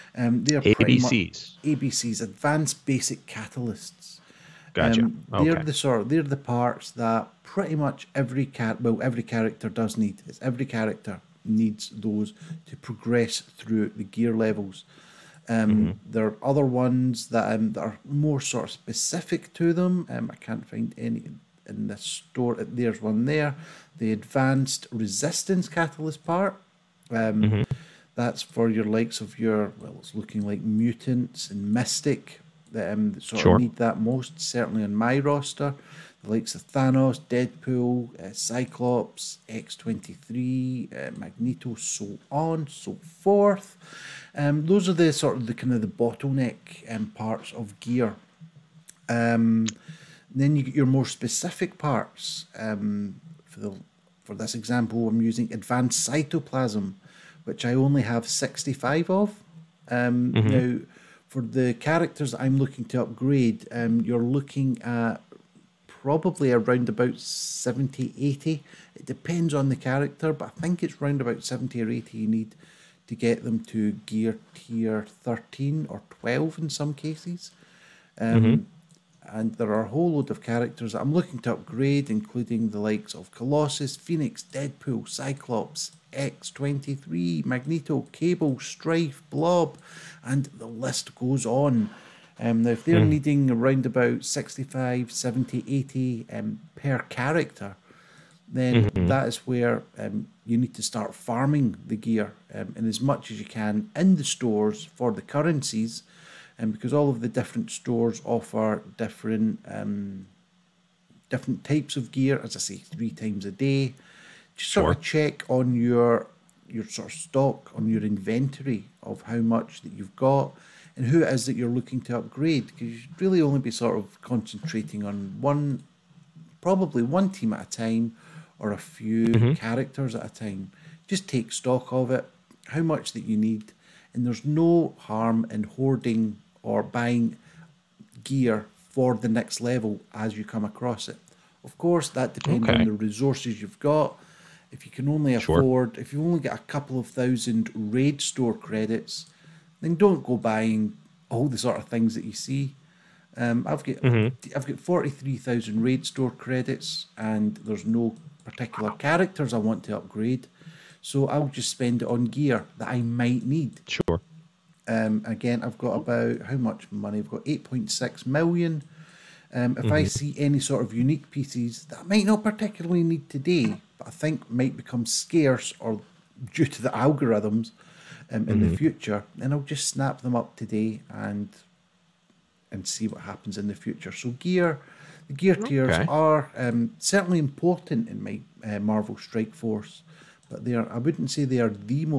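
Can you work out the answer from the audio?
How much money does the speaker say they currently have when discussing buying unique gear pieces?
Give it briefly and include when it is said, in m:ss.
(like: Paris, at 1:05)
8.6 million, at 2:47.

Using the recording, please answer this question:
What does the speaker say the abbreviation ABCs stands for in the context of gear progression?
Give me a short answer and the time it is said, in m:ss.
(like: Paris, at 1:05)
Advanced basic catalysts, at 0:02.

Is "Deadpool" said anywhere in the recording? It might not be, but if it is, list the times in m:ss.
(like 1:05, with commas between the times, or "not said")
0:37, 1:24.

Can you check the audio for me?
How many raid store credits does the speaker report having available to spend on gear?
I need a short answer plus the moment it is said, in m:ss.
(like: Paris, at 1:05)
43,000, at 2:34.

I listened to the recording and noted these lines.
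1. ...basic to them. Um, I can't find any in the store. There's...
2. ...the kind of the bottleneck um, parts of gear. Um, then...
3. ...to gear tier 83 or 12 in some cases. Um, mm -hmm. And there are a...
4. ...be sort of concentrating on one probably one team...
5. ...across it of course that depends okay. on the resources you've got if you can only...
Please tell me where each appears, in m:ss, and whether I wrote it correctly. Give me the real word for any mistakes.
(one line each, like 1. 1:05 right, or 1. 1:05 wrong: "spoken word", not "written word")
1. 0:18 wrong: "specific", not "basic"
2. 0:45 right
3. 1:13 wrong: "13", not "83"
4. 2:03 right
5. 2:20 right.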